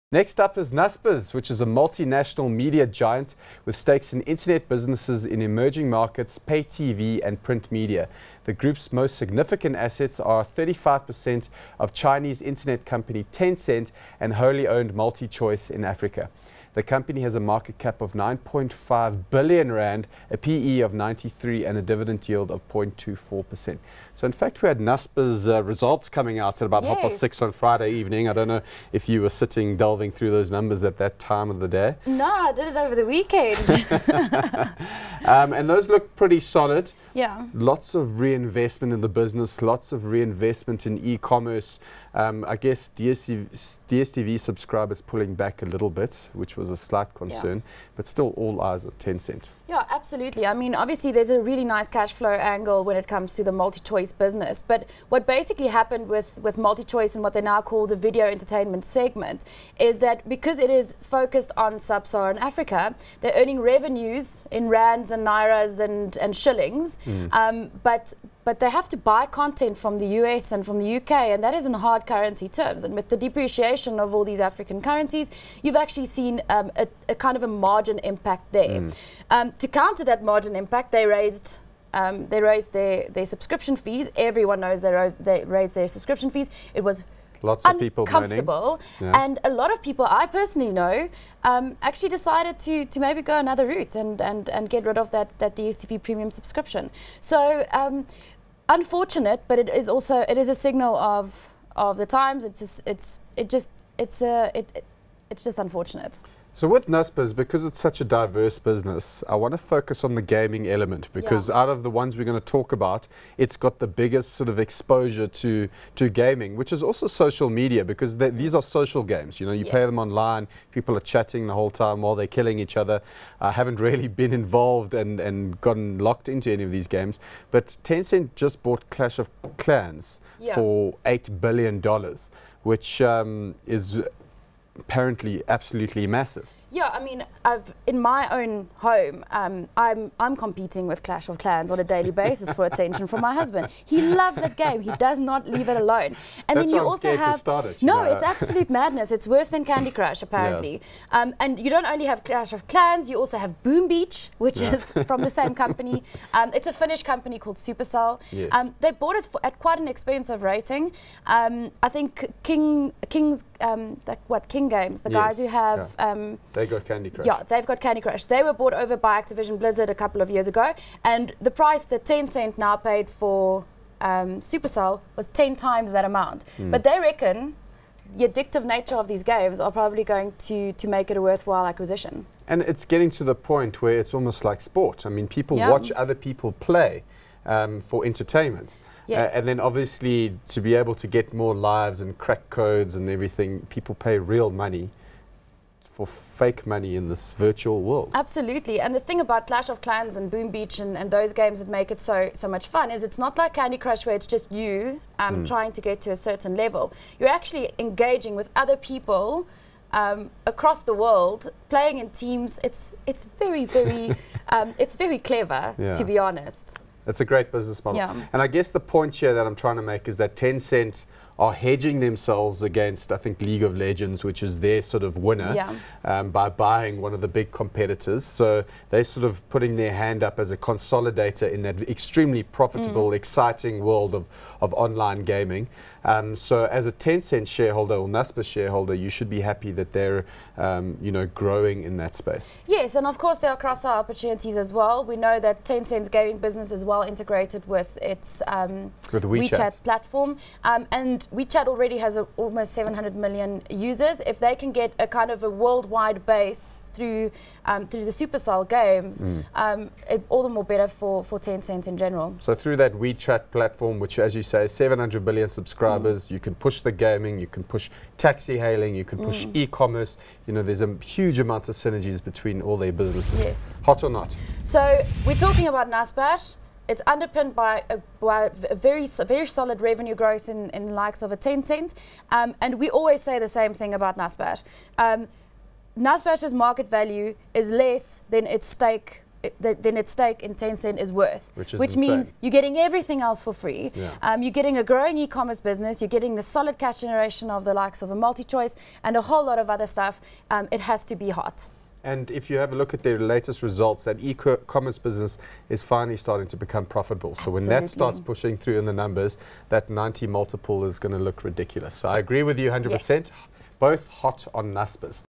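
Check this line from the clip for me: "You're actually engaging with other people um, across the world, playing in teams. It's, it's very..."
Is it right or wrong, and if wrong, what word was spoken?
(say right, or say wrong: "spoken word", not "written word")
right.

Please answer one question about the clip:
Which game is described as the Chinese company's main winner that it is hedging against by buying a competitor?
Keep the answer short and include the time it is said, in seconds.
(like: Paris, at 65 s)
League of Legends, at 223 s.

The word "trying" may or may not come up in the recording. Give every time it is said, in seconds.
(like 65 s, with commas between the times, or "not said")
205 s, 219 s.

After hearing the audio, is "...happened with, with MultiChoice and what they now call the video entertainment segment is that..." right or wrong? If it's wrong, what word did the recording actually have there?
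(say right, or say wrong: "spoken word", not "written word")
right.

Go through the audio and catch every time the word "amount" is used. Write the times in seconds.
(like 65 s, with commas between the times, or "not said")
176 s, 271 s.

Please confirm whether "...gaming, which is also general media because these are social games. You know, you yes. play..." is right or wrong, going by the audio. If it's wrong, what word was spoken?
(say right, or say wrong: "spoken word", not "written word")
wrong: "social", not "general".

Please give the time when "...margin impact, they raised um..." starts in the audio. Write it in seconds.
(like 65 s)
80 s.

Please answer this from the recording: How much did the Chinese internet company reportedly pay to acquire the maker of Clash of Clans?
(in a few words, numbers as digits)
$8 billion.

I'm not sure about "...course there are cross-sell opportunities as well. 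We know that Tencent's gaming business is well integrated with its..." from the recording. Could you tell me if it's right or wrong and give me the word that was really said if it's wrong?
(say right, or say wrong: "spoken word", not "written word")
right.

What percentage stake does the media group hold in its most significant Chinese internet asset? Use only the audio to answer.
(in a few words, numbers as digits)
35%.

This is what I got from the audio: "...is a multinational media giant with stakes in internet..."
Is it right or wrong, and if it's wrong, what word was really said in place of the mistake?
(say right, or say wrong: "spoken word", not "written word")
right.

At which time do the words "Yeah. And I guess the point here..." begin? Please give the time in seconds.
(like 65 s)
217 s.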